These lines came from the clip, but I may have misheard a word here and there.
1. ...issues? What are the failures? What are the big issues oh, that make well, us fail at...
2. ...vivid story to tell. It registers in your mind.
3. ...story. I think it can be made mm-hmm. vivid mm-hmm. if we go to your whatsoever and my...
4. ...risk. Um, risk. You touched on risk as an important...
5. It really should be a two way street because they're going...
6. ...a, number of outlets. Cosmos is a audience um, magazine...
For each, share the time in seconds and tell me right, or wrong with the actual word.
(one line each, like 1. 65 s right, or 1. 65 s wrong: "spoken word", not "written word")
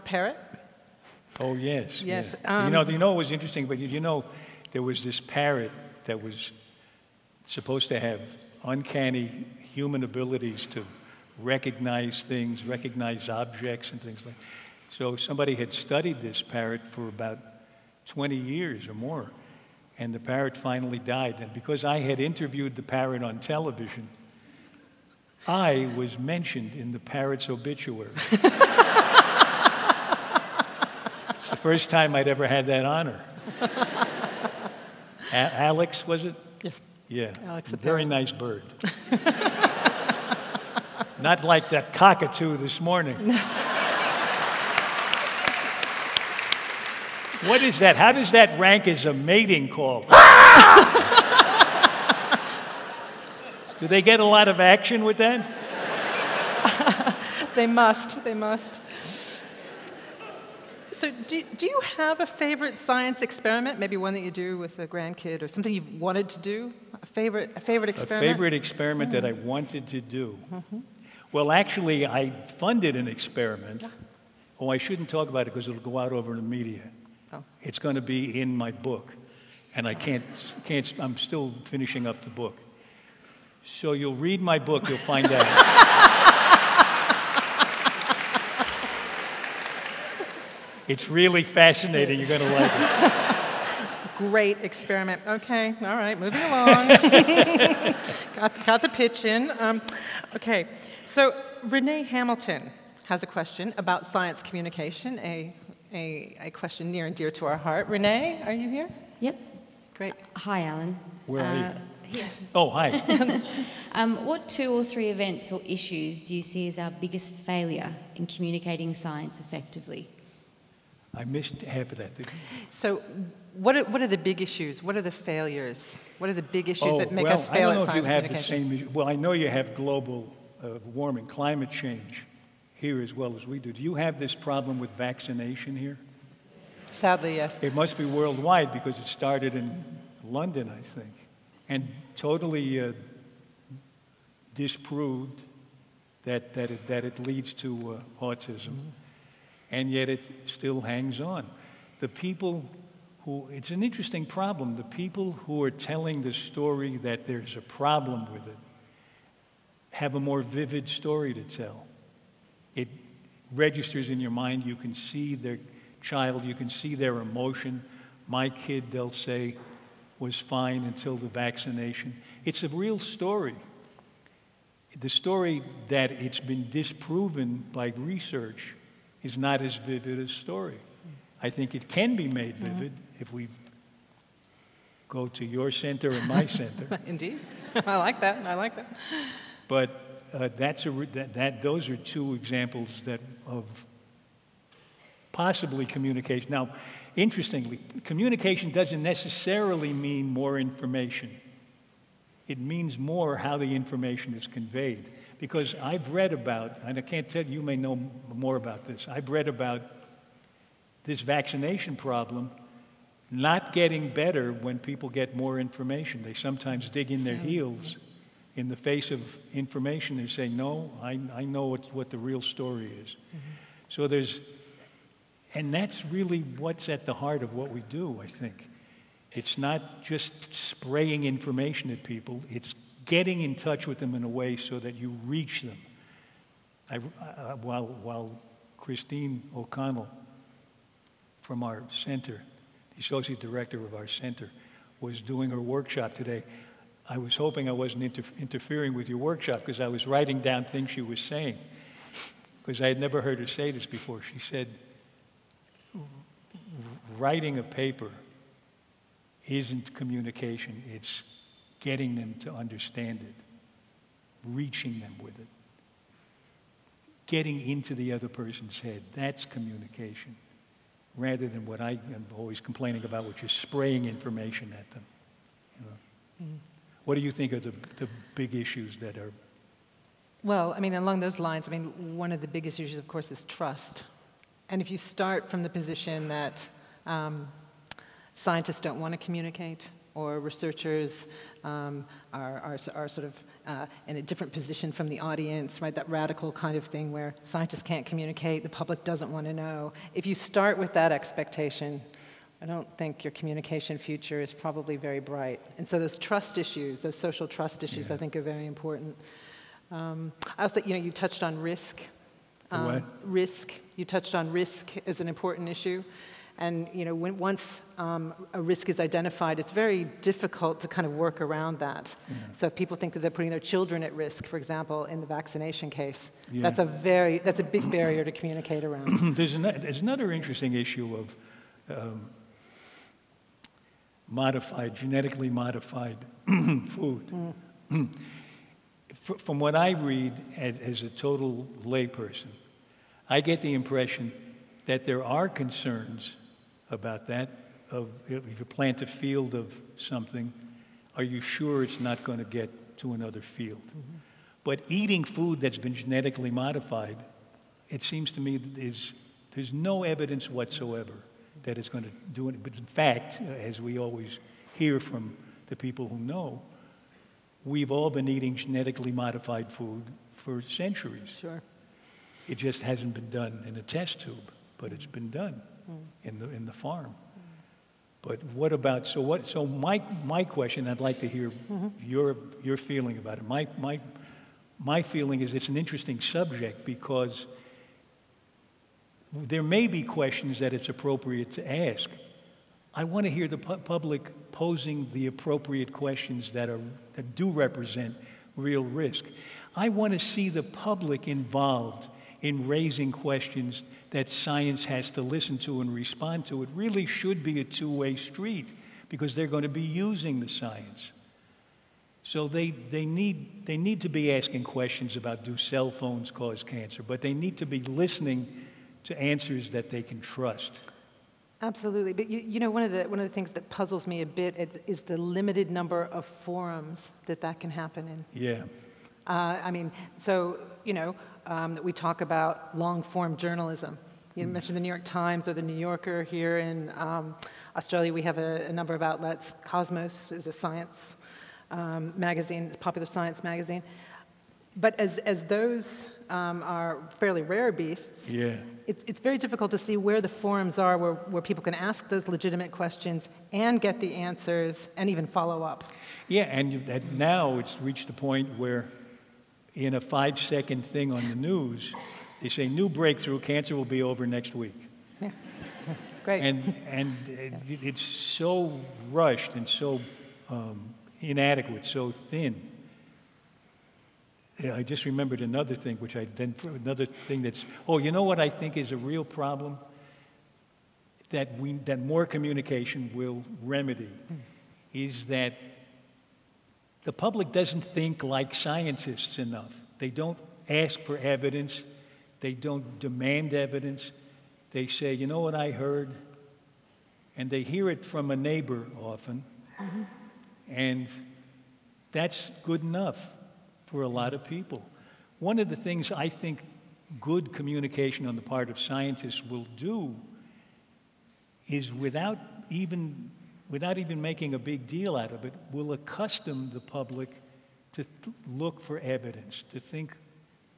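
1. 124 s right
2. 160 s right
3. 180 s wrong: "center", not "whatsoever"
4. 311 s right
5. 406 s right
6. 438 s wrong: "science", not "audience".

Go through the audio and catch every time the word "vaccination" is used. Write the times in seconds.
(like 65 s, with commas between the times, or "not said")
134 s, 171 s, 211 s, 325 s.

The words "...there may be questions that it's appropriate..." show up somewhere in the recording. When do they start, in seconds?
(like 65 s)
389 s.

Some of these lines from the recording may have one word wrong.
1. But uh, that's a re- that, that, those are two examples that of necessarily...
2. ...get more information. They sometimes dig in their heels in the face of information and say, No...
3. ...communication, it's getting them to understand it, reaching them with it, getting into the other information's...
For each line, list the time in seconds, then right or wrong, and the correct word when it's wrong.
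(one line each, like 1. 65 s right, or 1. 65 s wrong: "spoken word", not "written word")
1. 189 s wrong: "possibly", not "necessarily"
2. 215 s right
3. 259 s wrong: "person", not "information".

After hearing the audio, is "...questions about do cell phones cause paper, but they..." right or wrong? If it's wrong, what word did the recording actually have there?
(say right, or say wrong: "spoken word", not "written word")
wrong: "cancer", not "paper".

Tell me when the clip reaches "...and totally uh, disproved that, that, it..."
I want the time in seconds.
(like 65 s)
141 s.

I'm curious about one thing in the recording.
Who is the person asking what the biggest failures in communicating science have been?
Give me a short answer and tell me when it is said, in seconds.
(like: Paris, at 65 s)
Renee Hamilton, at 101 s.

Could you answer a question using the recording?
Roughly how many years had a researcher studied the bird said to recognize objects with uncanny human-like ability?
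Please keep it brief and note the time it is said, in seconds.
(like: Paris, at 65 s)
20, at 18 s.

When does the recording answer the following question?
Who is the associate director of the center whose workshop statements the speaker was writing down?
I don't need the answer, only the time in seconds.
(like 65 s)
238 s.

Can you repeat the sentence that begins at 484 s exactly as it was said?
is that the public doesn't think like scientists enough.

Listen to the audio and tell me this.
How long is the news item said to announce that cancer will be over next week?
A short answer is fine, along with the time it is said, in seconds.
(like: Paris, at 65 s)
5 seconds, at 460 s.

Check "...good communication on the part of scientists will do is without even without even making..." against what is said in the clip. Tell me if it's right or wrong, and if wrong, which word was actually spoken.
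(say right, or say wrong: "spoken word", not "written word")
right.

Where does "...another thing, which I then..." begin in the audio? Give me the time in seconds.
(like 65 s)
475 s.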